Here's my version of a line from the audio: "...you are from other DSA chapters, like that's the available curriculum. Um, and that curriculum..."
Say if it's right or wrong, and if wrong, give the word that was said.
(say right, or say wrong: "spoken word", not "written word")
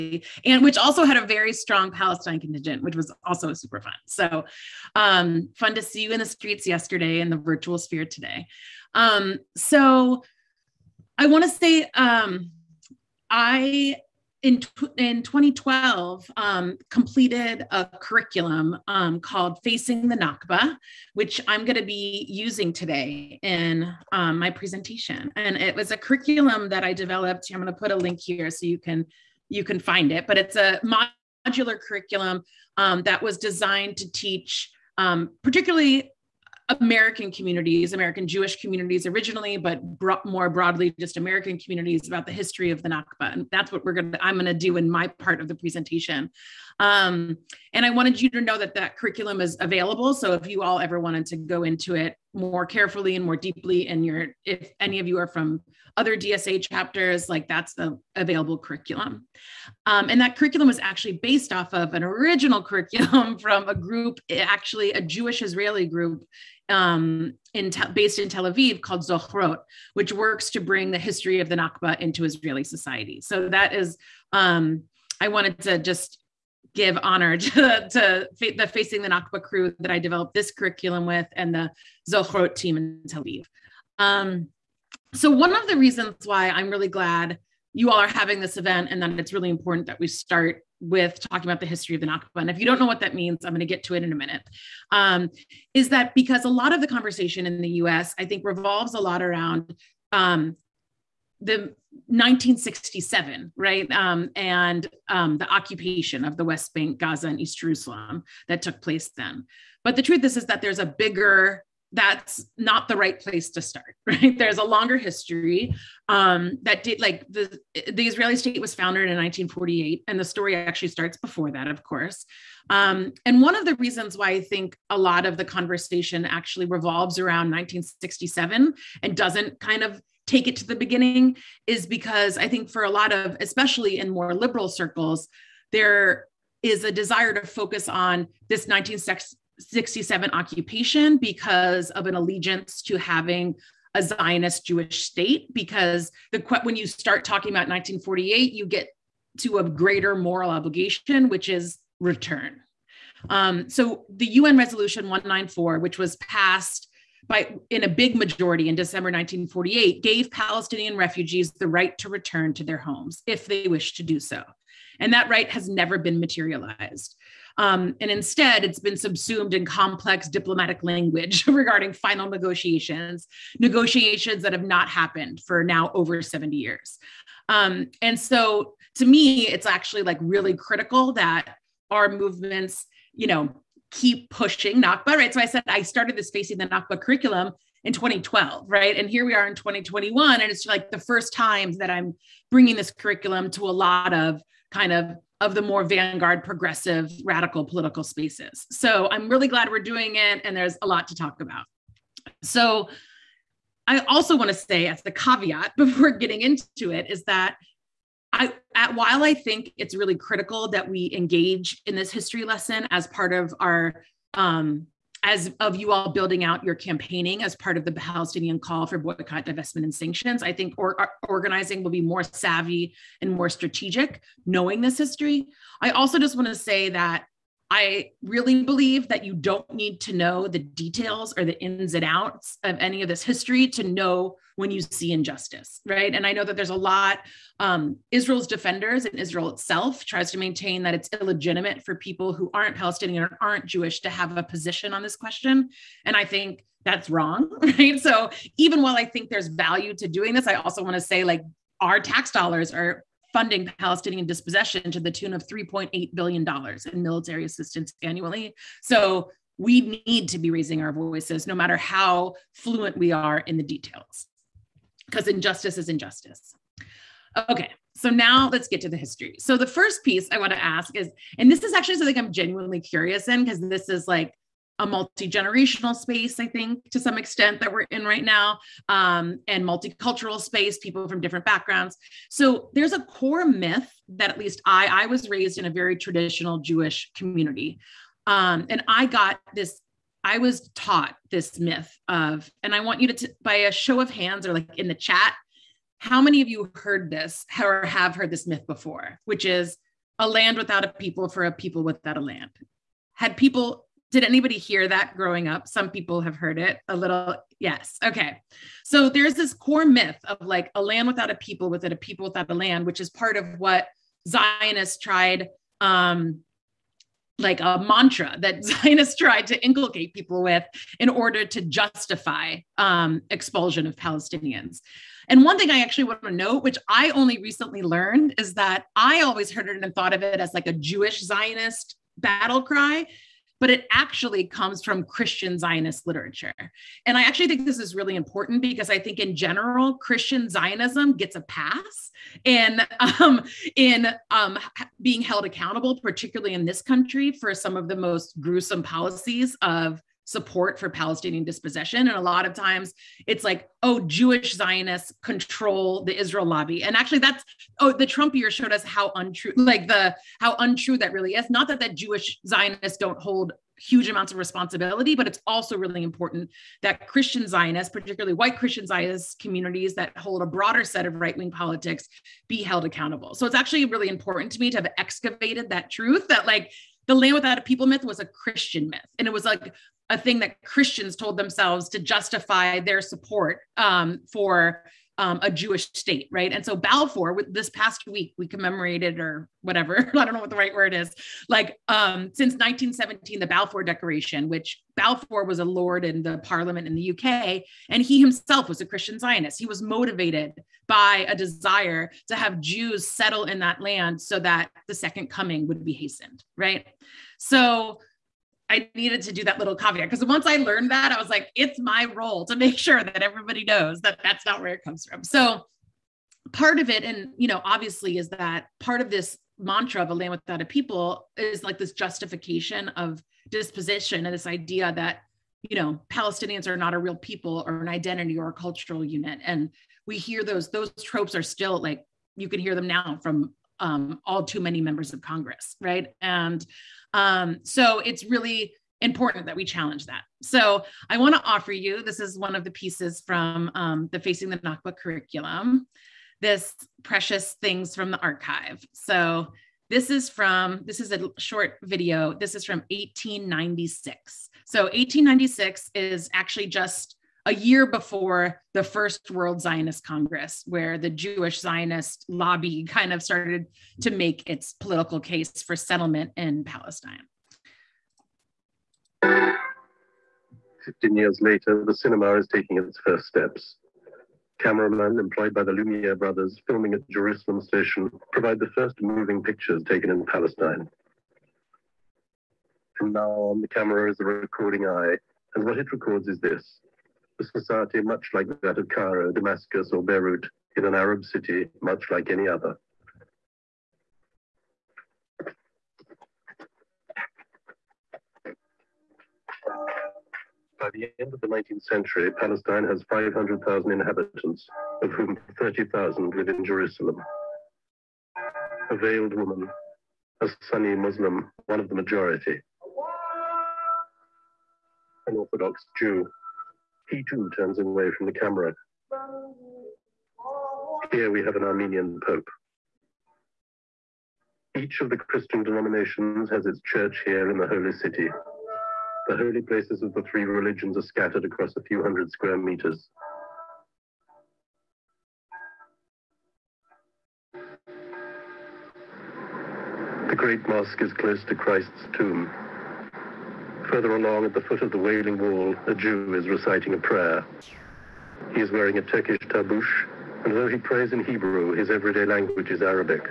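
right.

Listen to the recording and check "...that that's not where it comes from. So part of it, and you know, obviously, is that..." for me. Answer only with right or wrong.
right.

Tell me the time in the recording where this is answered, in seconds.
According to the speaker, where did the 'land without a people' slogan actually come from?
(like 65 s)
335 s.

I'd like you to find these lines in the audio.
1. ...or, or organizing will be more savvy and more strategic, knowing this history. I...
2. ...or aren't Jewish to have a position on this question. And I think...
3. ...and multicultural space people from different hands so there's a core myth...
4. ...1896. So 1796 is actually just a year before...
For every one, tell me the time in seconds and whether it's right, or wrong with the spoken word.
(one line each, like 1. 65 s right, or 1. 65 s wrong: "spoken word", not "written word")
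1. 220 s right
2. 243 s right
3. 279 s wrong: "backgrounds", not "hands"
4. 452 s wrong: "1896", not "1796".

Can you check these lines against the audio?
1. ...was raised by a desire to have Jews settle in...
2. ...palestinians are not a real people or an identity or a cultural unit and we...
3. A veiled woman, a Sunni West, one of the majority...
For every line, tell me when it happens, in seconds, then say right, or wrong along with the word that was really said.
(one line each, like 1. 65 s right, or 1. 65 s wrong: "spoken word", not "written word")
1. 399 s wrong: "motivated", not "raised"
2. 426 s right
3. 508 s wrong: "Muslim", not "West".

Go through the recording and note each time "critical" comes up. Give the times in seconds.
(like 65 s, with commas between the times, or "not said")
180 s, 210 s.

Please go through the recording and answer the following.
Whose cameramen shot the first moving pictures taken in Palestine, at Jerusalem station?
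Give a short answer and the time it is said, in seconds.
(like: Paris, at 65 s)
the Lumiere brothers, at 475 s.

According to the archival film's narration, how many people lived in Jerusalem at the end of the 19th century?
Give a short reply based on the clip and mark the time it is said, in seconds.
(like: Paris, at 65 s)
30,000, at 505 s.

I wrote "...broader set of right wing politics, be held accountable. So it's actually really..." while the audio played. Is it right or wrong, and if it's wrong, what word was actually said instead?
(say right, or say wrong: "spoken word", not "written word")
right.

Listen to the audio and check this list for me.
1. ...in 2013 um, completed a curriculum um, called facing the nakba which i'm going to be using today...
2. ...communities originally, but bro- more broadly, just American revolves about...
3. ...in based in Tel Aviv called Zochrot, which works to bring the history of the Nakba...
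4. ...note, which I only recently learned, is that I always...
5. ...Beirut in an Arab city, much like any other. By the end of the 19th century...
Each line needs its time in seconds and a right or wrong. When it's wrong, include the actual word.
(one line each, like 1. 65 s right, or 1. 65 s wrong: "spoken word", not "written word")
1. 14 s wrong: "2012", not "2013"
2. 38 s wrong: "communities", not "revolves"
3. 67 s right
4. 326 s right
5. 490 s right.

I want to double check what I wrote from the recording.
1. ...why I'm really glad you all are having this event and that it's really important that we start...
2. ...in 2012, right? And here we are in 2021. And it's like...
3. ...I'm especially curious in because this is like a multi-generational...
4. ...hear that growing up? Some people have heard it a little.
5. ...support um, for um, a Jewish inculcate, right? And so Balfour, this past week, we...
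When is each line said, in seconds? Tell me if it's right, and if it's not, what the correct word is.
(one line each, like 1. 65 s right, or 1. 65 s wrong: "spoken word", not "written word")
1. 86 s right
2. 187 s right
3. 272 s wrong: "genuinely", not "especially"
4. 304 s right
5. 383 s wrong: "state", not "inculcate".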